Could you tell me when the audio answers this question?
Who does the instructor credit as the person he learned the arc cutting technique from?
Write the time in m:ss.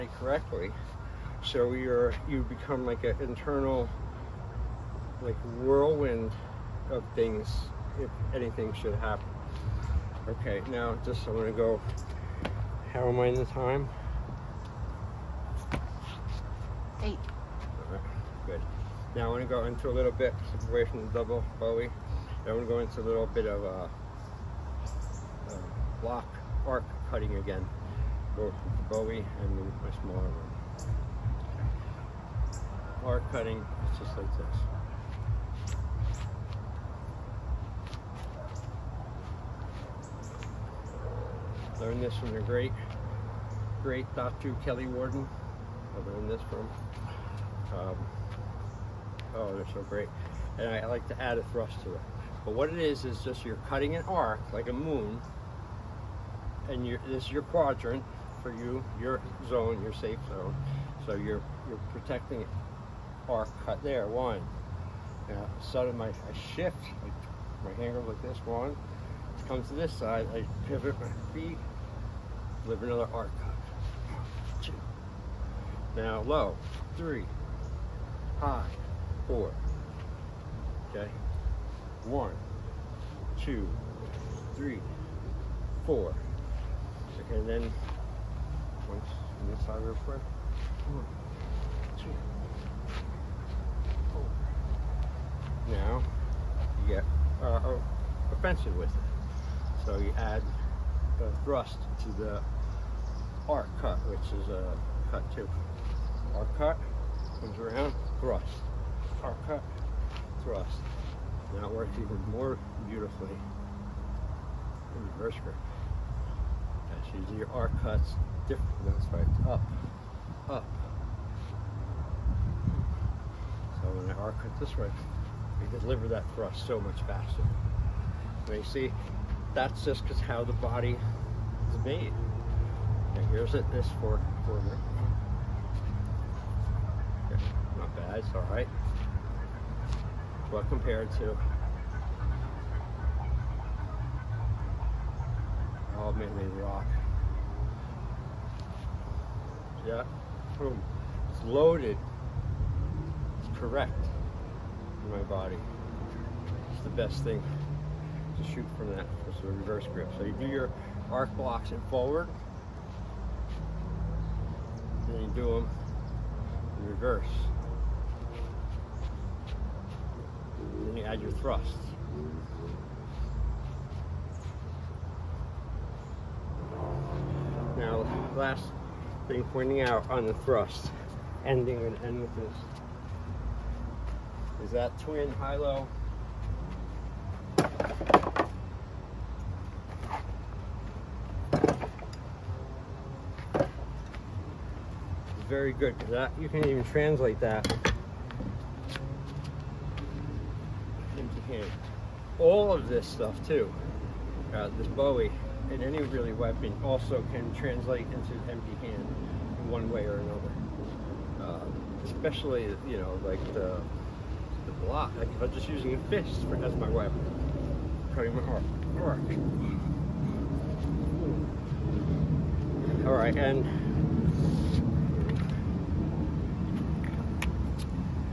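0:44.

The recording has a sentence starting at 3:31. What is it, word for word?
Uh, especially you know like the the block.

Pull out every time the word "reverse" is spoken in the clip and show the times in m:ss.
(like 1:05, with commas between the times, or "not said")
1:55, 2:39, 2:46.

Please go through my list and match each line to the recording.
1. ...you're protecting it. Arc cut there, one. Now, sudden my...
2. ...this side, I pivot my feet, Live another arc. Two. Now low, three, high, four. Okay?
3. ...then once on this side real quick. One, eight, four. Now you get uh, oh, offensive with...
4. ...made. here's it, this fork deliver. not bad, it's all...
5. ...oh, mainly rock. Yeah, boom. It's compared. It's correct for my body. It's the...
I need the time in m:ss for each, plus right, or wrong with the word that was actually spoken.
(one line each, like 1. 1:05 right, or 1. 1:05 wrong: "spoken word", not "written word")
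1. 1:01 right
2. 1:09 right
3. 1:27 wrong: "two", not "eight"
4. 2:11 wrong: "corner", not "deliver"
5. 2:26 wrong: "loaded", not "compared".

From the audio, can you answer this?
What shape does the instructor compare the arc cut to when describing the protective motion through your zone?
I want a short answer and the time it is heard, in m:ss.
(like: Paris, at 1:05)
a moon, at 0:54.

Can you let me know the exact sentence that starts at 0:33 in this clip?
Arc cutting, it's just like this.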